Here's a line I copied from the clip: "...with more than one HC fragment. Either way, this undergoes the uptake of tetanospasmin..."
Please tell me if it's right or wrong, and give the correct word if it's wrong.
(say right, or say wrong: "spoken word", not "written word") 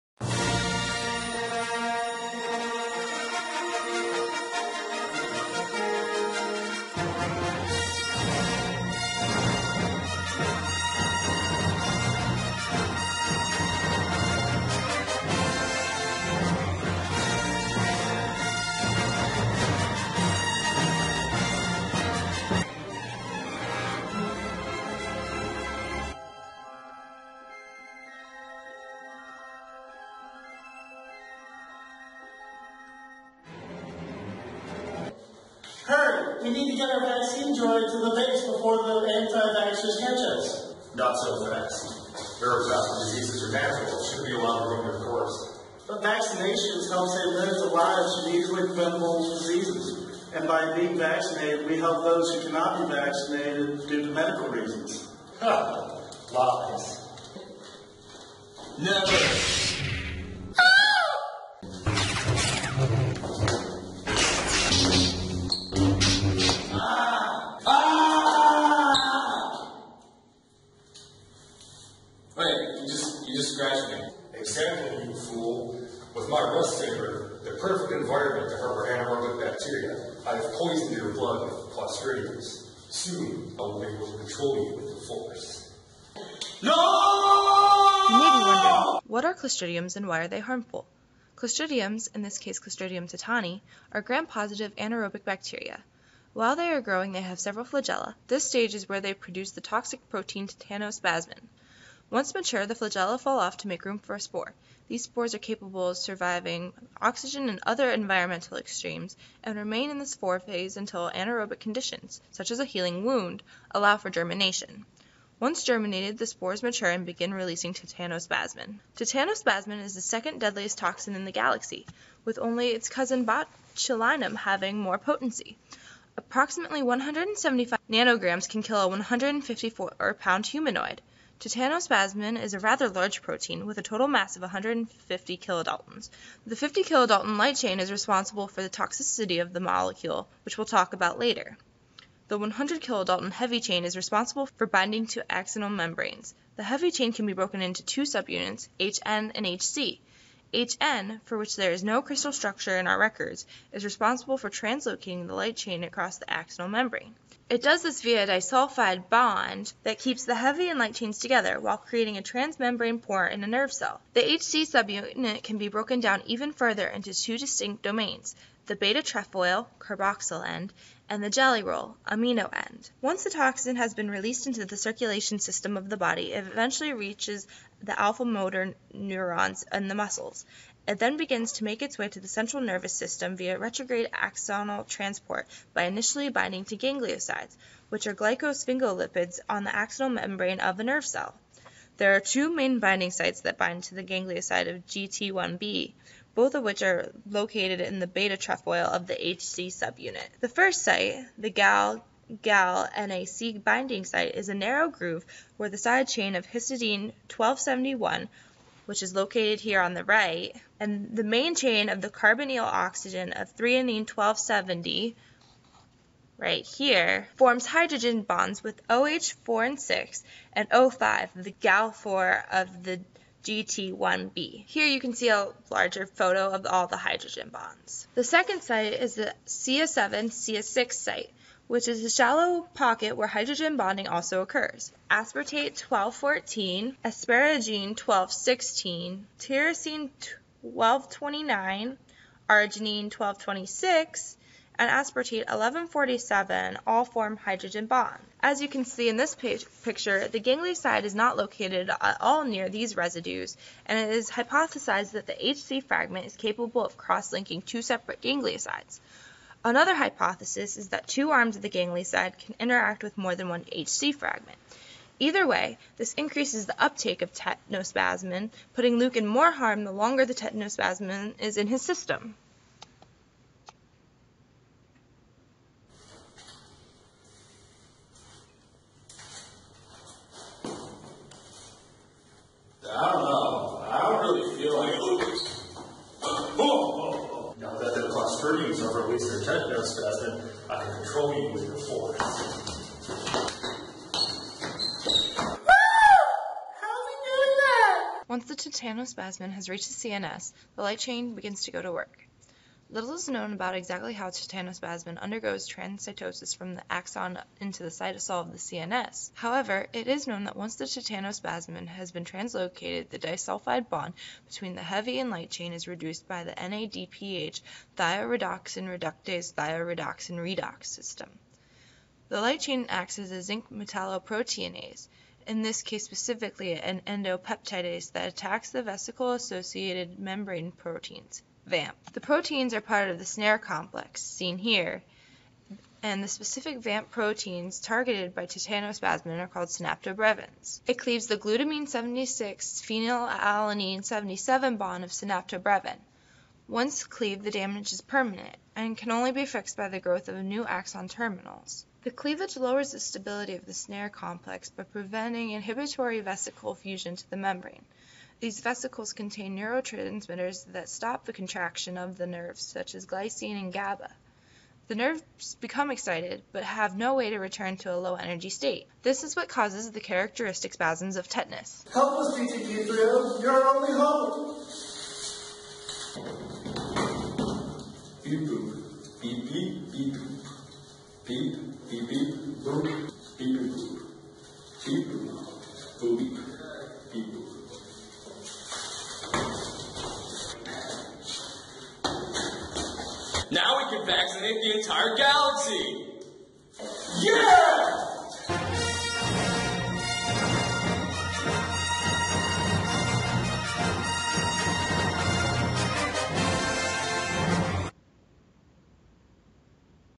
wrong: "increases", not "undergoes".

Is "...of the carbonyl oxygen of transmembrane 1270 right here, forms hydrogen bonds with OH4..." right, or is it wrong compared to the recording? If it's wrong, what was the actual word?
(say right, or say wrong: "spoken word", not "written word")
wrong: "threonine", not "transmembrane".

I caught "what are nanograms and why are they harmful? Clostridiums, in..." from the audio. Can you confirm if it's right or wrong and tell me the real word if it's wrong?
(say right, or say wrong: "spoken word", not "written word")
wrong: "clostridiums", not "nanograms".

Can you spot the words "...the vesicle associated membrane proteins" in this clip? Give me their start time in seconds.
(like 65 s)
328 s.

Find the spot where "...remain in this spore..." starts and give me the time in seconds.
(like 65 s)
109 s.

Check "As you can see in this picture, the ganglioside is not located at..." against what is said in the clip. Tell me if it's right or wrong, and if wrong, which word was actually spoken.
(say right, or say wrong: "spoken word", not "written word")
right.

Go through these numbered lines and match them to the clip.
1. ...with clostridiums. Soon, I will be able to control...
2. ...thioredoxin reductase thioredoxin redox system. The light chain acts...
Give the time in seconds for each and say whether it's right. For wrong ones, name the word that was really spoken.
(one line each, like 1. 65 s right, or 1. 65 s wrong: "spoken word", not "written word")
1. 81 s right
2. 317 s right.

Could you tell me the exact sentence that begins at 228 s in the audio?
The second site is the CS7, CS6 site, which is a shallow pocket where hydrogen bonding also occurs.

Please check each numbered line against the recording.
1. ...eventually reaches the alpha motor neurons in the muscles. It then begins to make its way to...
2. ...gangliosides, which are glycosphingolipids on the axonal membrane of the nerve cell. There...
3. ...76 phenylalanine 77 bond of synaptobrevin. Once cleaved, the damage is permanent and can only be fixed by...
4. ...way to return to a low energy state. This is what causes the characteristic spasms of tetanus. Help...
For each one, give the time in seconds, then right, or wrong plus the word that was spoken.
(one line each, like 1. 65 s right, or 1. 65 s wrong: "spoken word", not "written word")
1. 176 s right
2. 186 s right
3. 341 s right
4. 367 s right.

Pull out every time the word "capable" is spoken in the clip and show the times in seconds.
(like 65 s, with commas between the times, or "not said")
105 s, 256 s.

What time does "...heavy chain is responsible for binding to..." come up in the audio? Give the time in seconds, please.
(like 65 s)
143 s.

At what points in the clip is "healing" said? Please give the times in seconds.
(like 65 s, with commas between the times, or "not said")
112 s.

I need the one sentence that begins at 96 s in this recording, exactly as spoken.
While they are growing, they have several flagella.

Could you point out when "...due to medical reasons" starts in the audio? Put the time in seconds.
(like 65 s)
53 s.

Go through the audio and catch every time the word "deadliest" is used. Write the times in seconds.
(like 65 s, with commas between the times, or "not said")
120 s.